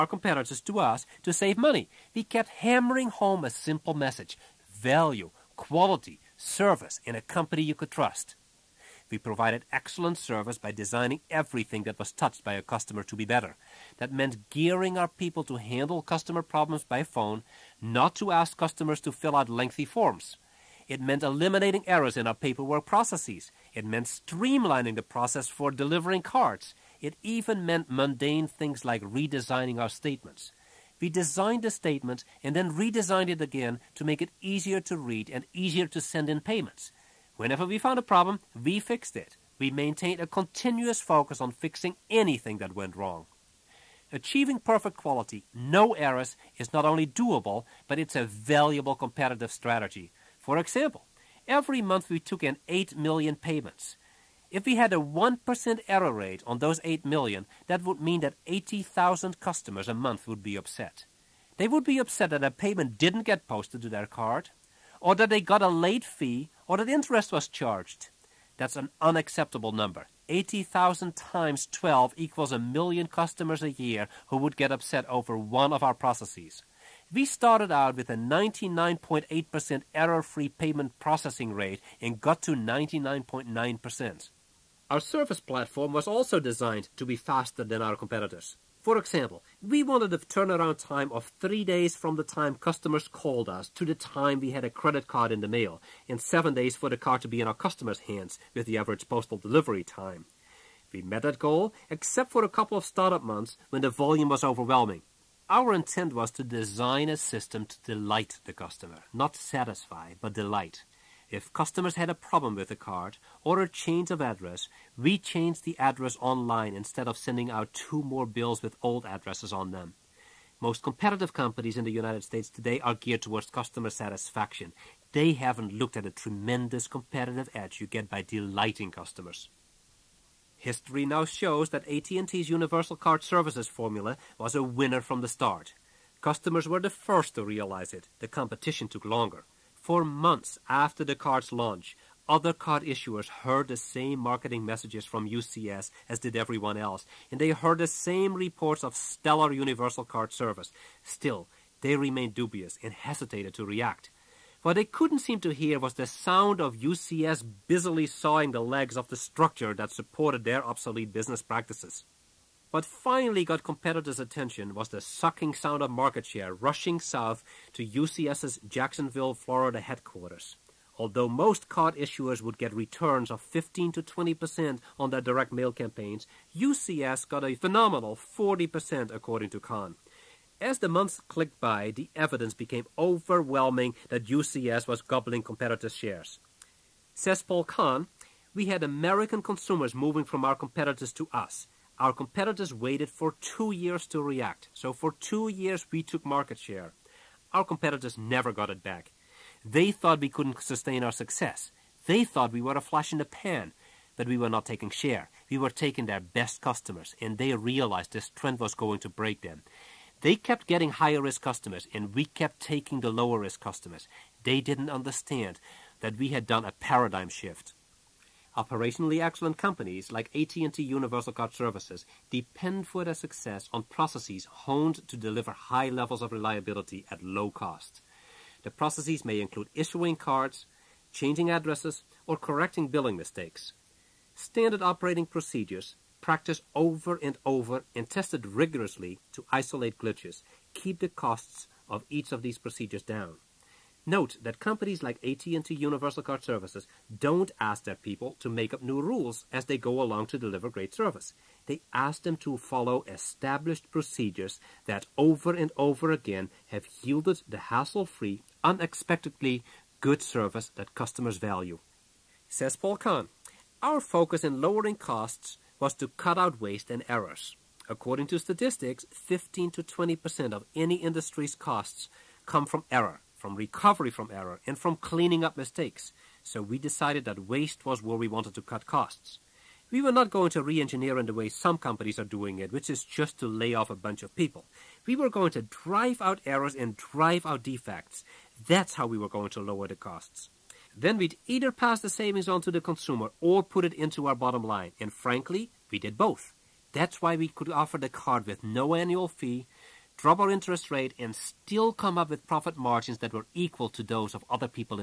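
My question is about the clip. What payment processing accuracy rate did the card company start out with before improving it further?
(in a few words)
99.8%.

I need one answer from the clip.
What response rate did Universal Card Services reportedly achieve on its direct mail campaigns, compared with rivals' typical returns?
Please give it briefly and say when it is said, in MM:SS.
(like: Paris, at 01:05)
40%, at 02:58.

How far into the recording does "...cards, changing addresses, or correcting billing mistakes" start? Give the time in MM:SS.
03:50.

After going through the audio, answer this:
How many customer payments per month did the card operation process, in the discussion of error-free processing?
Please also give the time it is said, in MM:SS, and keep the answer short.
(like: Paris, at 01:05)
8 million, at 00:52.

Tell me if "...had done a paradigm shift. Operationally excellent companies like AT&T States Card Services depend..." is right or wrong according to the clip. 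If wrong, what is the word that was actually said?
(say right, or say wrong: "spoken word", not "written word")
wrong: "Universal", not "States".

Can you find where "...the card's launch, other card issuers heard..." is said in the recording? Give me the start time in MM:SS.
02:21.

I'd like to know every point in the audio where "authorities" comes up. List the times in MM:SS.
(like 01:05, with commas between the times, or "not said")
not said.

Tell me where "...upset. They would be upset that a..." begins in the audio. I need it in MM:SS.
01:00.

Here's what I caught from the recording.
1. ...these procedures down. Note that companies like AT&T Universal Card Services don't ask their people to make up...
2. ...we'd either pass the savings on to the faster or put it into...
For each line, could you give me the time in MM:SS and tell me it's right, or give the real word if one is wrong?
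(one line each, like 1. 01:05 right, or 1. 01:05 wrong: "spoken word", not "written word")
1. 04:02 right
2. 04:51 wrong: "consumer", not "faster".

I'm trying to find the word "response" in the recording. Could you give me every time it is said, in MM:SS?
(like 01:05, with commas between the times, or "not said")
not said.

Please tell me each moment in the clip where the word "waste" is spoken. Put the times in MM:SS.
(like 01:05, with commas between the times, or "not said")
04:26, 04:37.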